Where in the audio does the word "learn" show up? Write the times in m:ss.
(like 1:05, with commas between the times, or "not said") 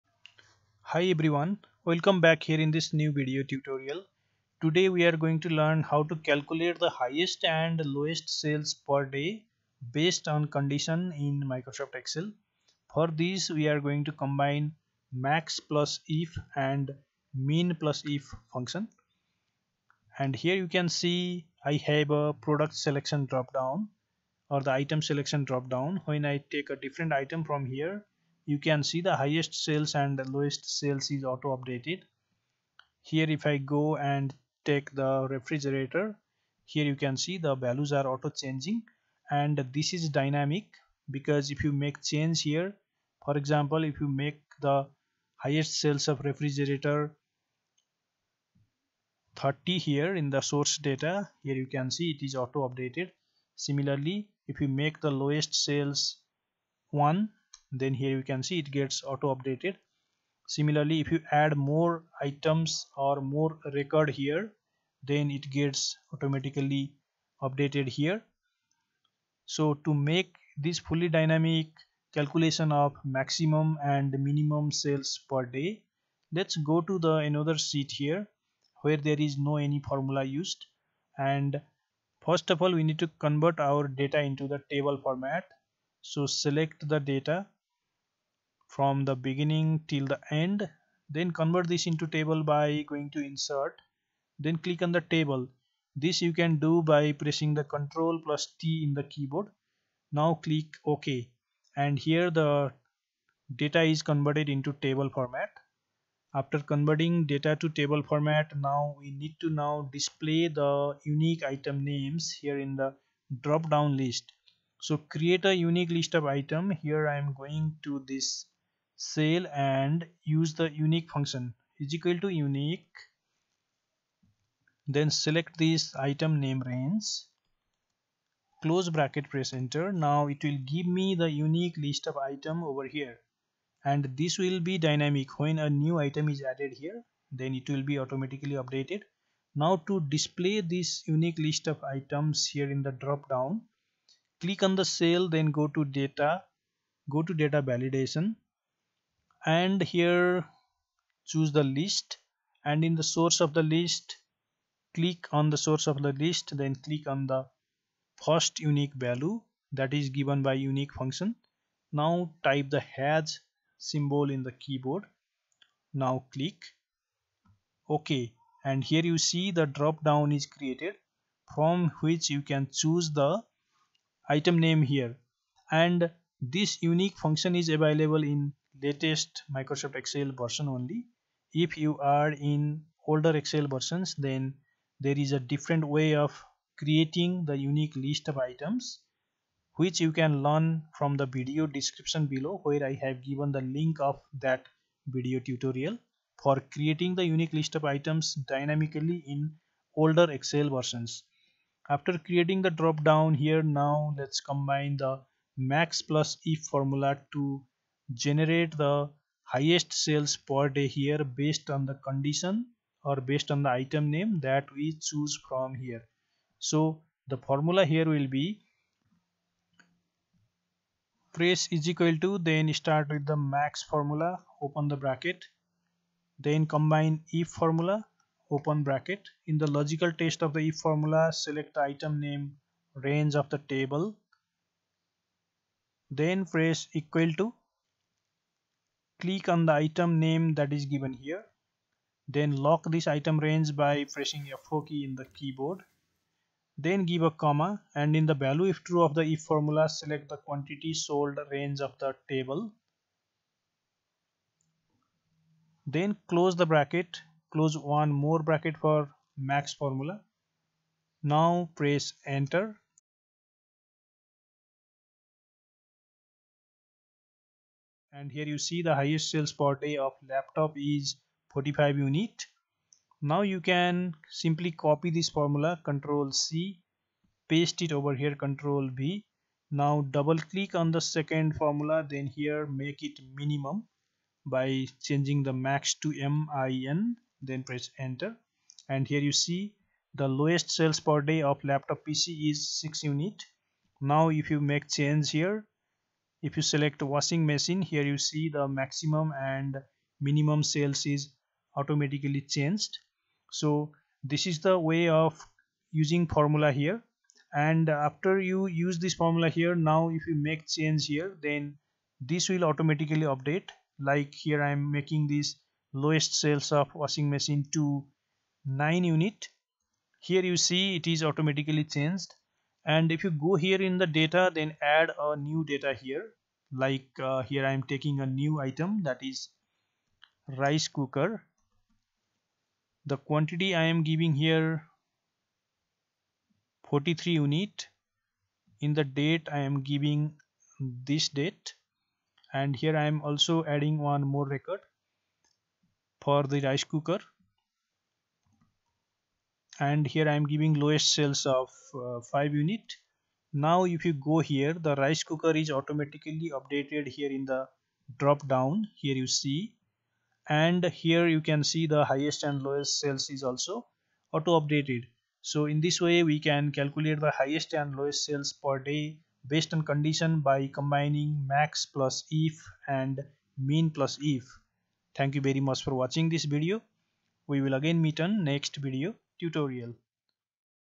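0:05, 3:10.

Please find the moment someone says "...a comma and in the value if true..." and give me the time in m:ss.
4:07.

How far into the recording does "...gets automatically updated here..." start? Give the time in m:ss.
1:05.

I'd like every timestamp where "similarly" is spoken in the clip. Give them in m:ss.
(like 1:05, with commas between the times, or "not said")
0:53, 1:00.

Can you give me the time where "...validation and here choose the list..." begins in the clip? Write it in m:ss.
2:27.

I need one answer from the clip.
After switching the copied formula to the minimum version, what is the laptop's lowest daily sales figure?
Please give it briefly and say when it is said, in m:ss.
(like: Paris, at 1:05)
6, at 4:52.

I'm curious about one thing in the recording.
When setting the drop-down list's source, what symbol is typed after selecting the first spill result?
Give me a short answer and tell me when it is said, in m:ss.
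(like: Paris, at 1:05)
Hash, at 2:42.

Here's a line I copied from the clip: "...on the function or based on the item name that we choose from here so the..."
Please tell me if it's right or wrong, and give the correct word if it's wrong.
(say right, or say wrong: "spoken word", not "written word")
wrong: "condition", not "function".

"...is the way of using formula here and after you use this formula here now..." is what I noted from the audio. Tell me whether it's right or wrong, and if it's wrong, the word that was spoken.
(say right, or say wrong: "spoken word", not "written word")
right.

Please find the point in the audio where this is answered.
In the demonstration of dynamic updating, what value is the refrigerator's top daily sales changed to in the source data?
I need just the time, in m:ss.
0:49.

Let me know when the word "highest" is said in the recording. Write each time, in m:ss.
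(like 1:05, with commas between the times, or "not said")
0:06, 0:29, 0:45, 3:29, 4:28, 6:02, 6:07.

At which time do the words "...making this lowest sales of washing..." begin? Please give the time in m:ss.
5:14.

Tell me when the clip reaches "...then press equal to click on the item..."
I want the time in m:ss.
3:56.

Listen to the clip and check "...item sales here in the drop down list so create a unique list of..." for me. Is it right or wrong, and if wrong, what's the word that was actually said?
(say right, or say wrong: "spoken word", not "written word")
wrong: "names", not "sales".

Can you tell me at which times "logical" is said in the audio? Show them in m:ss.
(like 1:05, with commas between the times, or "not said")
3:49.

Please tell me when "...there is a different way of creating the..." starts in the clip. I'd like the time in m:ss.
3:04.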